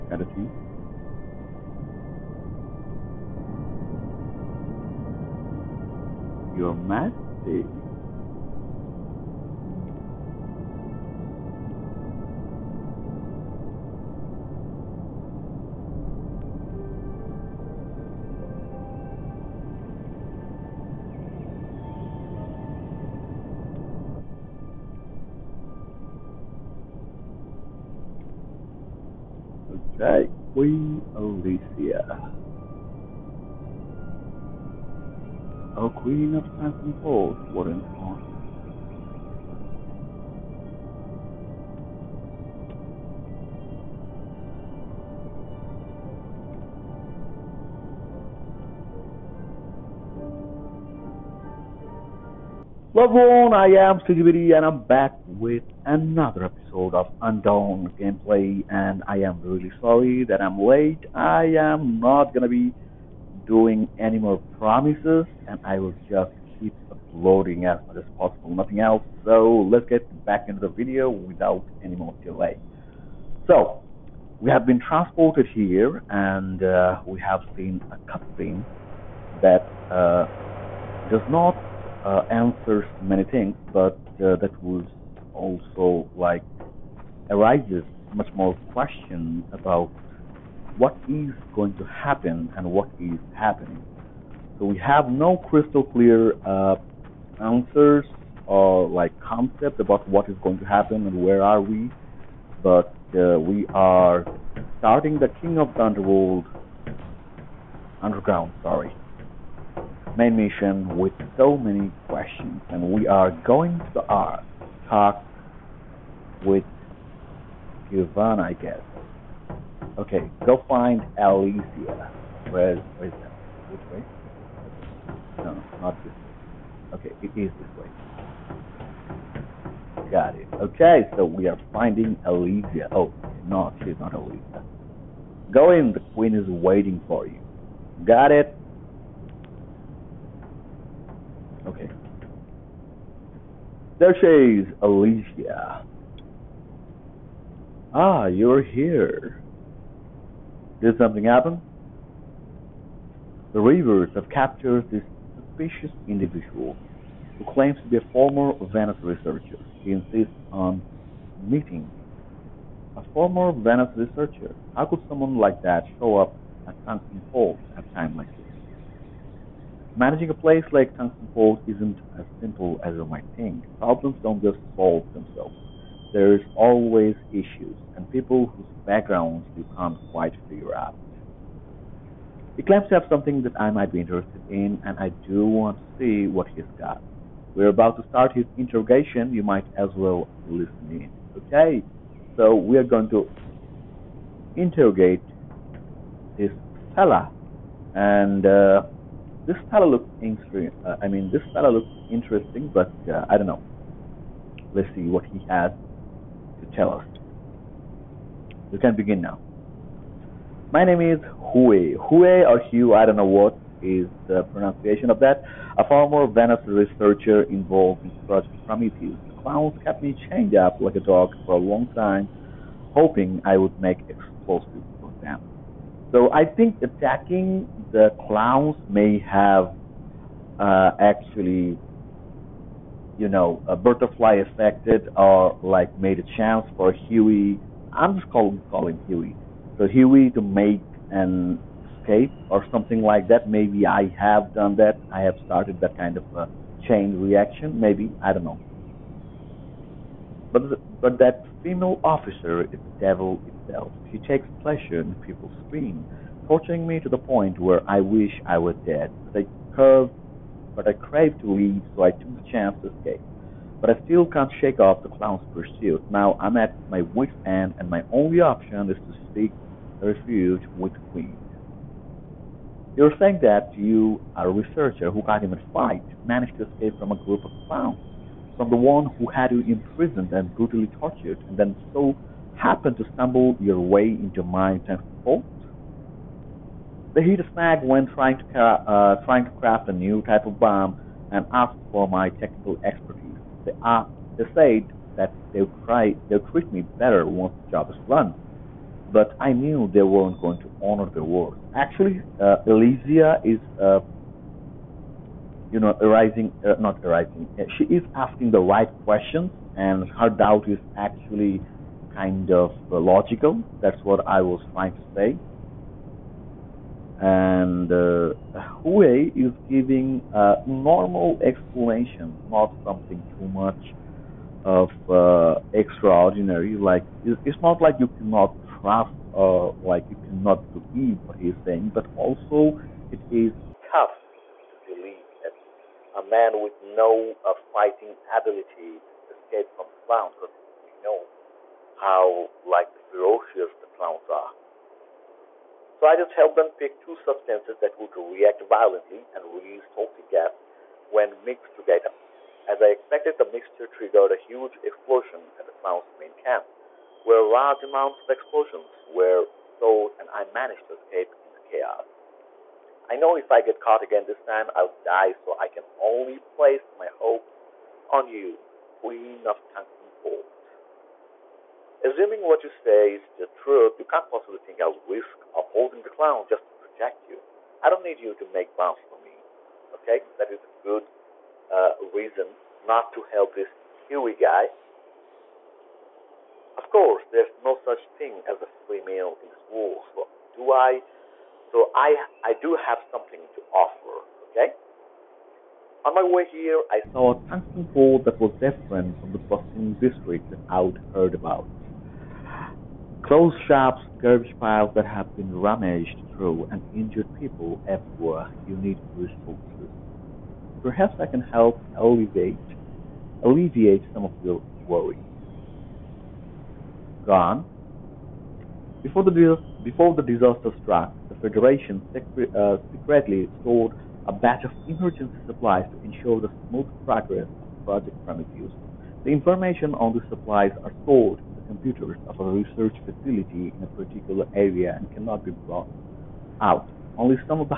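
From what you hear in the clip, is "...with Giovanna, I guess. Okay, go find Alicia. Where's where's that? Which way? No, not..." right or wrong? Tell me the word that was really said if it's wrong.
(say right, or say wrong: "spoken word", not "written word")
right.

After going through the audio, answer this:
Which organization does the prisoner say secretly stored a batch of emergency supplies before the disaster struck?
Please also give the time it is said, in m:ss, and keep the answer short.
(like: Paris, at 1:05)
The Federation, at 7:01.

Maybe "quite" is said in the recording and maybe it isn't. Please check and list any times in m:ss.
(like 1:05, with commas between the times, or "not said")
3:00.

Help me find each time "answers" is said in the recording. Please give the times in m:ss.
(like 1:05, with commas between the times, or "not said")
1:22, 1:37.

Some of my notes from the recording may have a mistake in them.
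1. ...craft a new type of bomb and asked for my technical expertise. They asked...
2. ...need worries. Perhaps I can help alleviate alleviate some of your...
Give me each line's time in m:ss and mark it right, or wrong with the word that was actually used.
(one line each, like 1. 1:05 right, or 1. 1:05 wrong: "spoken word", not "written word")
1. 4:49 right
2. 6:48 wrong: "resources", not "worries".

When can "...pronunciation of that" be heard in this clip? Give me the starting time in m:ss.
3:34.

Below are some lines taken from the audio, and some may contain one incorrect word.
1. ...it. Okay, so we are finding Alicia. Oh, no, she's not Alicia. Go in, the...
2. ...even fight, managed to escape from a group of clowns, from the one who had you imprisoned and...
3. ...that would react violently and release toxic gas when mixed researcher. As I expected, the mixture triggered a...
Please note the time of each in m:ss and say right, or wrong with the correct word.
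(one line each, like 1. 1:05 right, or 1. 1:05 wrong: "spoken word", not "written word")
1. 2:10 right
2. 4:35 right
3. 5:47 wrong: "together", not "researcher".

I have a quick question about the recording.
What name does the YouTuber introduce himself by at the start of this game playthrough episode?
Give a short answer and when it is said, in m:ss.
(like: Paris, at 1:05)
Stigibiri, at 0:54.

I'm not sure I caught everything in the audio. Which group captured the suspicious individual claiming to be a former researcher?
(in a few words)
The Reavers.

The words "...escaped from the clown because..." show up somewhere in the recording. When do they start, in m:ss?
5:39.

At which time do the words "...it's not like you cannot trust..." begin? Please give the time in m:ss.
5:27.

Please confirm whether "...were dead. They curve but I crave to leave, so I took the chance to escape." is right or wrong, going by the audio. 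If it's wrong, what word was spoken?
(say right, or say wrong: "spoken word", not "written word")
right.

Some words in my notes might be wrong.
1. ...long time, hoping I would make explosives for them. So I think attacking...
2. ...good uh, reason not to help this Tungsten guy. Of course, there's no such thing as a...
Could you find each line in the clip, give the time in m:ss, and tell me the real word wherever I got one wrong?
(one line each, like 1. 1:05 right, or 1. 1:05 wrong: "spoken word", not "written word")
1. 3:41 right
2. 6:20 wrong: "Huey", not "Tungsten".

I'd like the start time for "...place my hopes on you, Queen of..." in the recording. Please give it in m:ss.
6:06.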